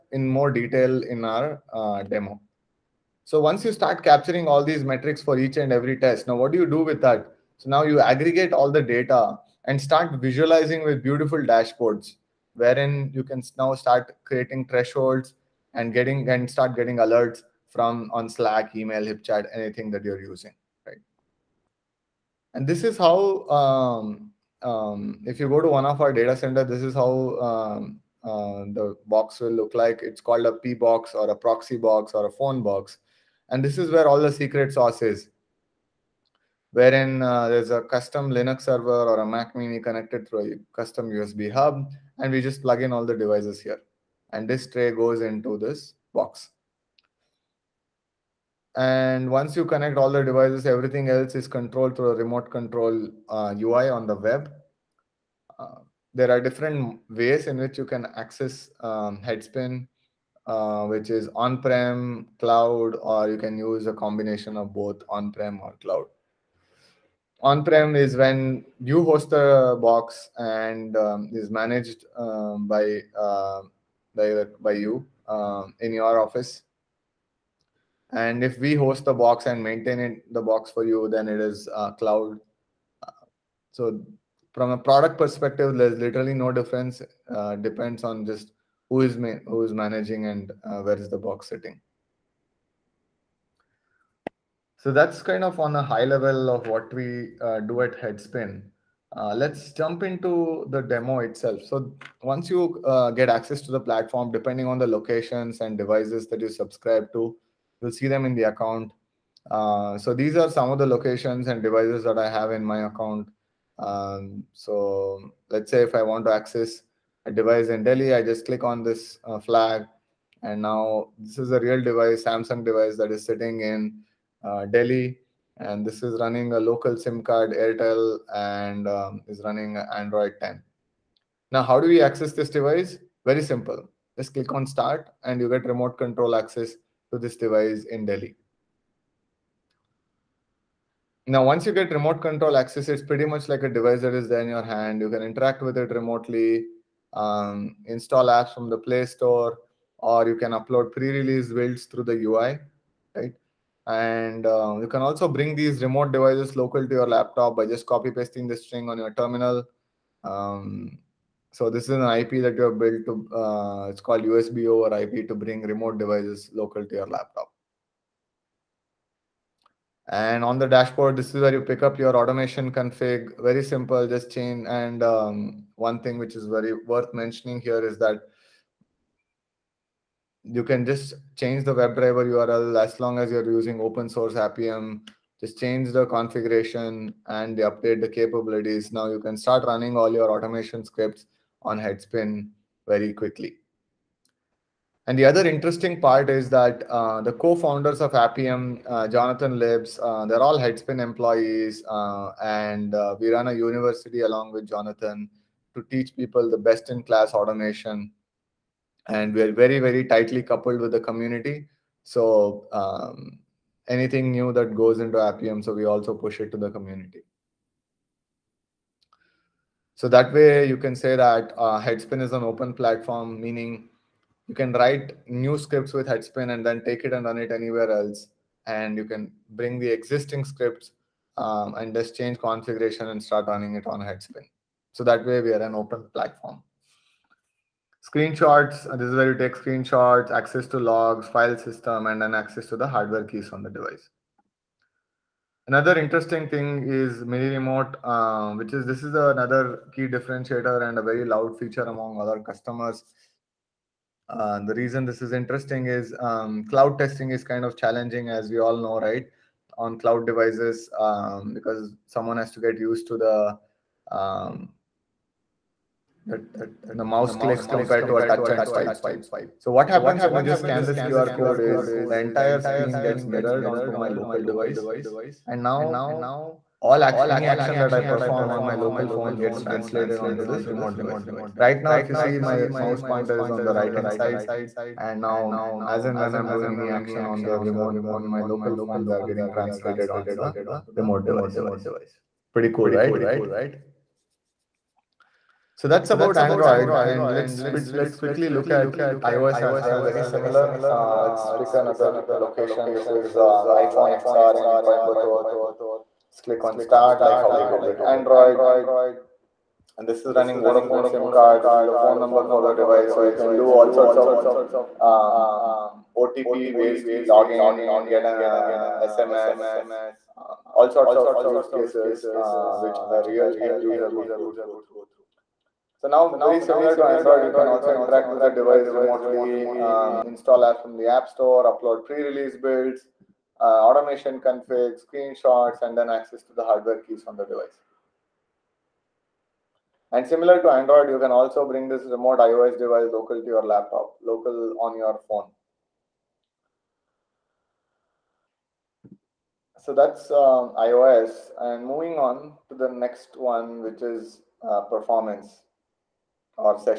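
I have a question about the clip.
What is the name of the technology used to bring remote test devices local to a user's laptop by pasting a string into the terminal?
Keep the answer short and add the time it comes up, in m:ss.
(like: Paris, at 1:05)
USB over IP, at 2:44.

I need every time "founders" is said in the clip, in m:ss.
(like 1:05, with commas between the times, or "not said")
3:17.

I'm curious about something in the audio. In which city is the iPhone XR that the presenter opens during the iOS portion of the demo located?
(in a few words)
Coimbatore.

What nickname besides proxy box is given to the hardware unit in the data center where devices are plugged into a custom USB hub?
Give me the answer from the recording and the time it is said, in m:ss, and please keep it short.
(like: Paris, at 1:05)
phone box, at 0:32.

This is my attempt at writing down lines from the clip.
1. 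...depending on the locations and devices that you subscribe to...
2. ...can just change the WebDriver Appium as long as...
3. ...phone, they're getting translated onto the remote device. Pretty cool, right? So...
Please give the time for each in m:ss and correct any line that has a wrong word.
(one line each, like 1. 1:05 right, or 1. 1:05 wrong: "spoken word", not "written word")
1. 1:44 right
2. 3:00 wrong: "URL", not "Appium"
3. 4:48 right.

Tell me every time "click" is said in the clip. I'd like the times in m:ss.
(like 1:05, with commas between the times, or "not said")
1:58, 2:14, 4:27, 5:06.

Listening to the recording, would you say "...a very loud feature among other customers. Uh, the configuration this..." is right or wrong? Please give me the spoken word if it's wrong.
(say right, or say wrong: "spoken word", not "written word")
wrong: "reason", not "configuration".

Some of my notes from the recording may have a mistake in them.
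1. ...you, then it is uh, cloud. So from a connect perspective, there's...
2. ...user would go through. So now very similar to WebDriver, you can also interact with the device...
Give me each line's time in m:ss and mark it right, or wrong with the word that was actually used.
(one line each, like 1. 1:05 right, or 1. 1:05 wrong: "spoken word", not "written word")
1. 1:20 wrong: "product", not "connect"
2. 5:23 wrong: "Android", not "WebDriver".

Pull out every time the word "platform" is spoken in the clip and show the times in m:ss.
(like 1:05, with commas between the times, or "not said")
1:43, 3:42, 3:56.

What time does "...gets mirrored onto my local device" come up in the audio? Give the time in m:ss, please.
4:33.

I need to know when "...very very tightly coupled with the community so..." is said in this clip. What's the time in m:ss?
3:29.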